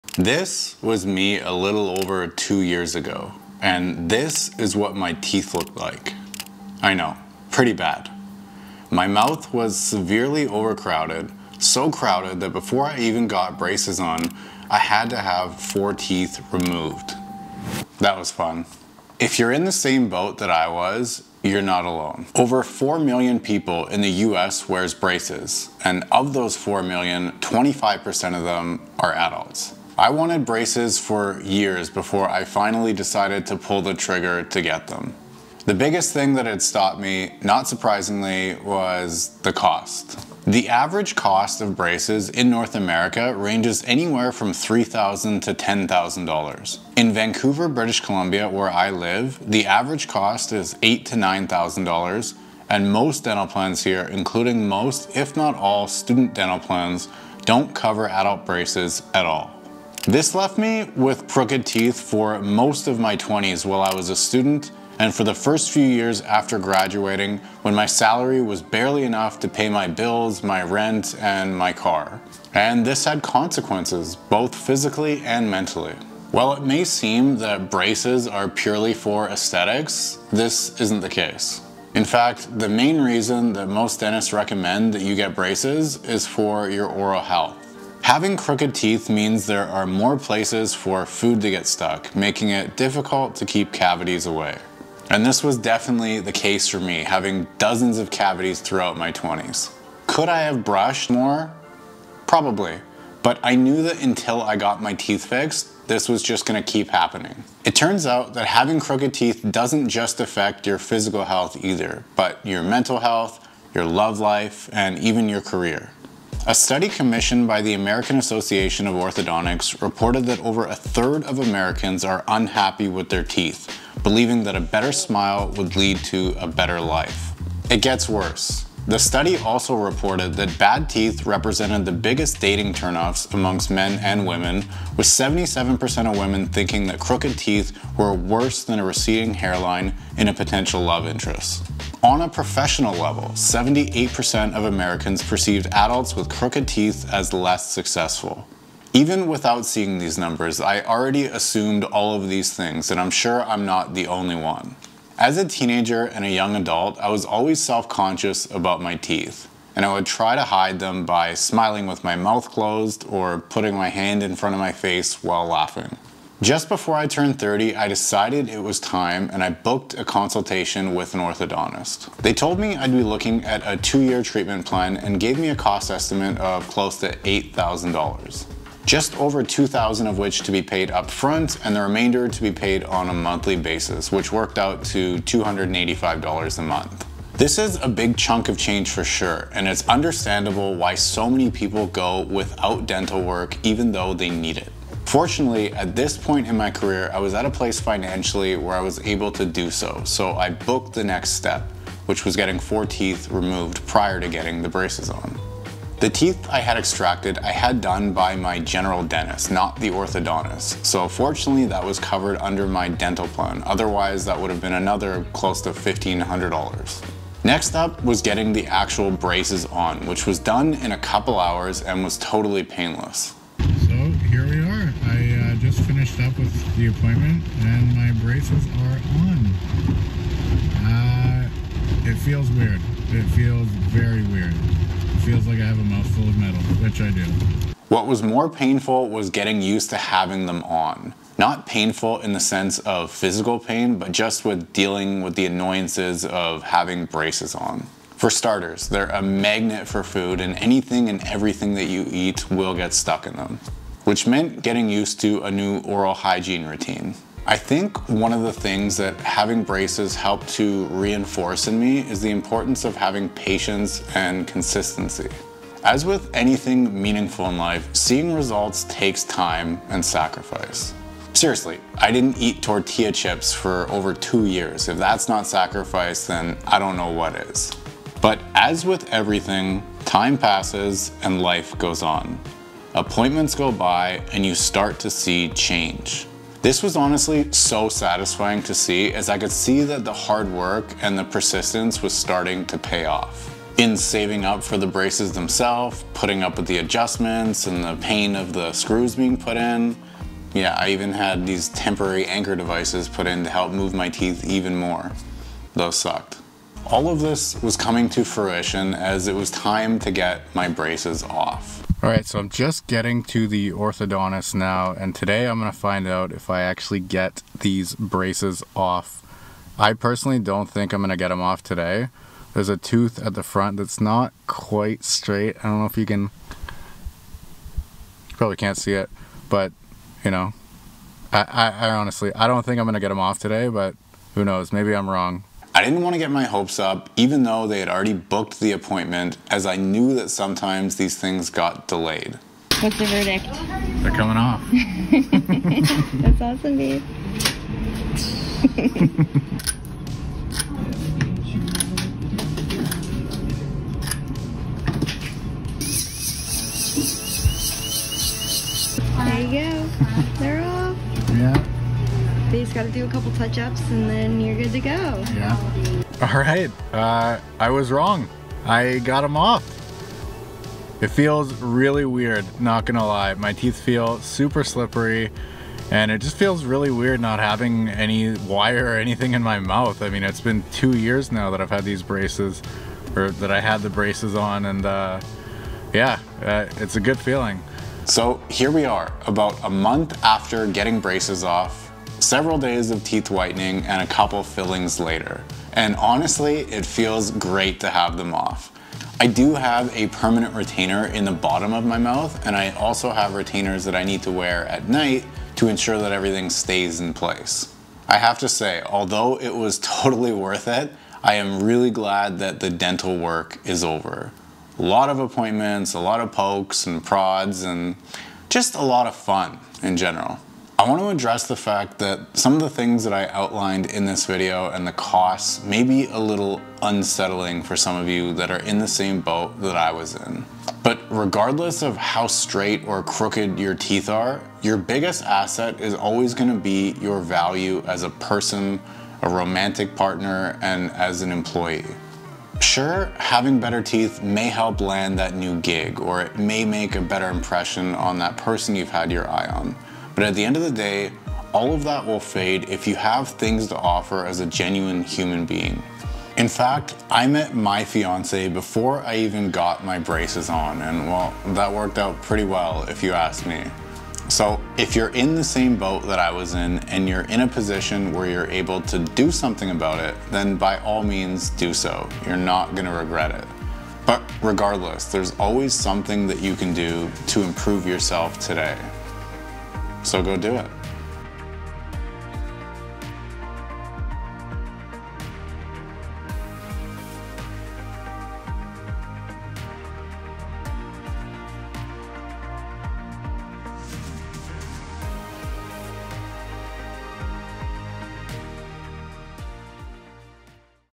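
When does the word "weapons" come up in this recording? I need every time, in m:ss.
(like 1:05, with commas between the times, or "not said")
not said.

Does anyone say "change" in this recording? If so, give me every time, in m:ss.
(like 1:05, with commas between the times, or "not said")
3:08, 4:45.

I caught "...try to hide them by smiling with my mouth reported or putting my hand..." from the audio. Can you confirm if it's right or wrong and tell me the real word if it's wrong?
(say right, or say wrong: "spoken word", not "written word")
wrong: "closed", not "reported".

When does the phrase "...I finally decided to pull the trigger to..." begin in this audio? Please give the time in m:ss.
0:32.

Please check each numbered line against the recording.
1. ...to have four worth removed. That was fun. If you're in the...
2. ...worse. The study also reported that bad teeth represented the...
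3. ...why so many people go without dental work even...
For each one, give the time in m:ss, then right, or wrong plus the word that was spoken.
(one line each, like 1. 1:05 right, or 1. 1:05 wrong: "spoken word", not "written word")
1. 0:15 wrong: "teeth", not "worth"
2. 2:08 right
3. 3:10 right.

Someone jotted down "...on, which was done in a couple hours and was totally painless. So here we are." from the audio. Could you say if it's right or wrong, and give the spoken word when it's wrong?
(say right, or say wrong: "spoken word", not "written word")
right.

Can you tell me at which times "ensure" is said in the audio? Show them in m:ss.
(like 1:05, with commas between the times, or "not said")
6:45.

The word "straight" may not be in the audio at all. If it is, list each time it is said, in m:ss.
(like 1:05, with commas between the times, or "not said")
5:25, 7:12.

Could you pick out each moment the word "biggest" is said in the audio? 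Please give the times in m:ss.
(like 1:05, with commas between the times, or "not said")
0:35, 2:11, 7:14.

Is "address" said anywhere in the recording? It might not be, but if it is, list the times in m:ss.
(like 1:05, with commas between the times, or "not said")
7:01.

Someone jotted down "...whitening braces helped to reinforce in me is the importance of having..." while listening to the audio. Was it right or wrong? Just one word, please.
wrong.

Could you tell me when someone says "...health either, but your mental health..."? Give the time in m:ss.
1:51.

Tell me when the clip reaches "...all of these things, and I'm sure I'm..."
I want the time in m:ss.
2:31.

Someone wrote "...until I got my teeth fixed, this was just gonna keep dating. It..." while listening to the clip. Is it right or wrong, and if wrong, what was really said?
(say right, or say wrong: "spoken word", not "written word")
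wrong: "happening", not "dating".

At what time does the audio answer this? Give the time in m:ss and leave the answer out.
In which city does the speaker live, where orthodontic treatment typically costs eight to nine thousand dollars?
0:47.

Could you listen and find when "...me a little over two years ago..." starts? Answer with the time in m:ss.
0:01.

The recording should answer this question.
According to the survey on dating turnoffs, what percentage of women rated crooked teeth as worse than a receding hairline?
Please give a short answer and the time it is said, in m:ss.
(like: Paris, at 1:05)
77%, at 2:15.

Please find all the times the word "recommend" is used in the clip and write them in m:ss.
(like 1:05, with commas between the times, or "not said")
1:24.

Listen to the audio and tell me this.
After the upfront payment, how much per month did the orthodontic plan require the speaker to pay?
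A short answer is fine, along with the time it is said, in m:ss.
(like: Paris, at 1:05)
$285, at 3:05.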